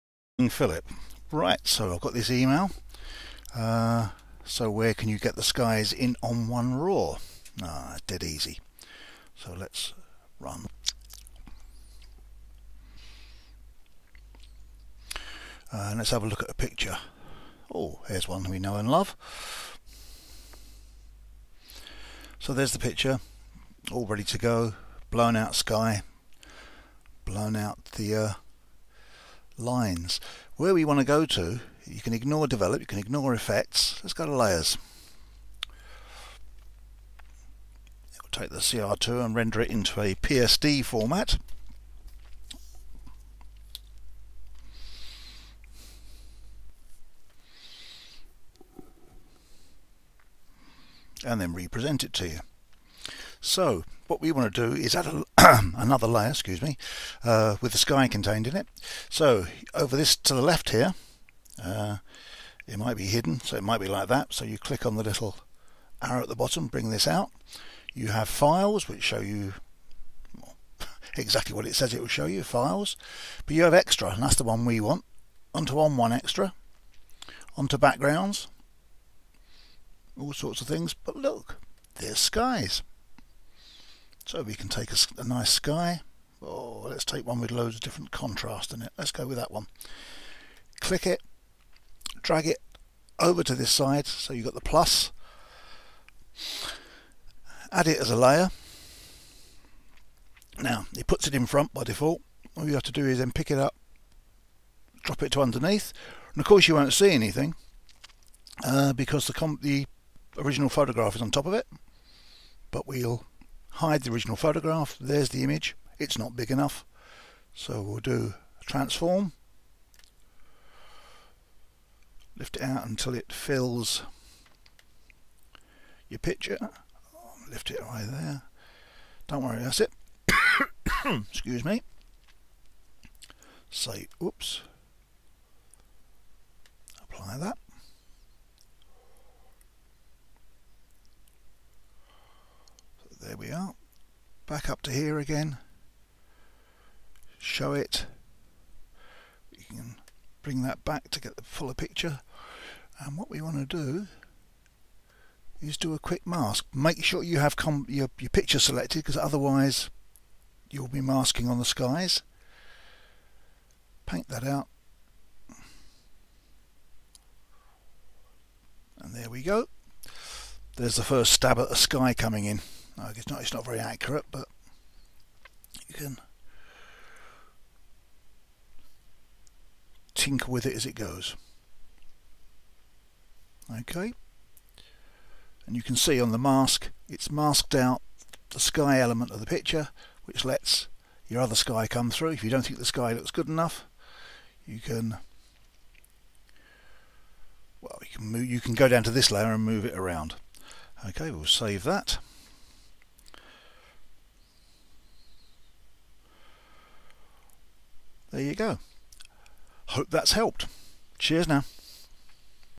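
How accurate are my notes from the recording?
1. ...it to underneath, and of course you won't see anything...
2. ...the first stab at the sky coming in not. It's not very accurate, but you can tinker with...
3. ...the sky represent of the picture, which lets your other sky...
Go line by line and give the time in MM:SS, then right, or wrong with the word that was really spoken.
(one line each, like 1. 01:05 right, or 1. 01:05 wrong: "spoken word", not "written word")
1. 01:45 right
2. 02:50 right
3. 03:08 wrong: "element", not "represent".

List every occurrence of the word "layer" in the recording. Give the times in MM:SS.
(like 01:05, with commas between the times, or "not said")
00:34, 00:56, 01:38, 03:19.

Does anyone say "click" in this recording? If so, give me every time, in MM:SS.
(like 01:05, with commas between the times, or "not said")
01:04, 01:30.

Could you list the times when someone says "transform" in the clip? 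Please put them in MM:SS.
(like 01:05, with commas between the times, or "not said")
01:58.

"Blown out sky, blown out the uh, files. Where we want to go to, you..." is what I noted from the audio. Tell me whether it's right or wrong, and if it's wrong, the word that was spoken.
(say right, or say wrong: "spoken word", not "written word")
wrong: "lines", not "files".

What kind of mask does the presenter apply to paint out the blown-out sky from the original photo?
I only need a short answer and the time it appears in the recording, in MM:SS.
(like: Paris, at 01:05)
Quick mask, at 02:35.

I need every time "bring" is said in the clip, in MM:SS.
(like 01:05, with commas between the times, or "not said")
01:06, 02:30.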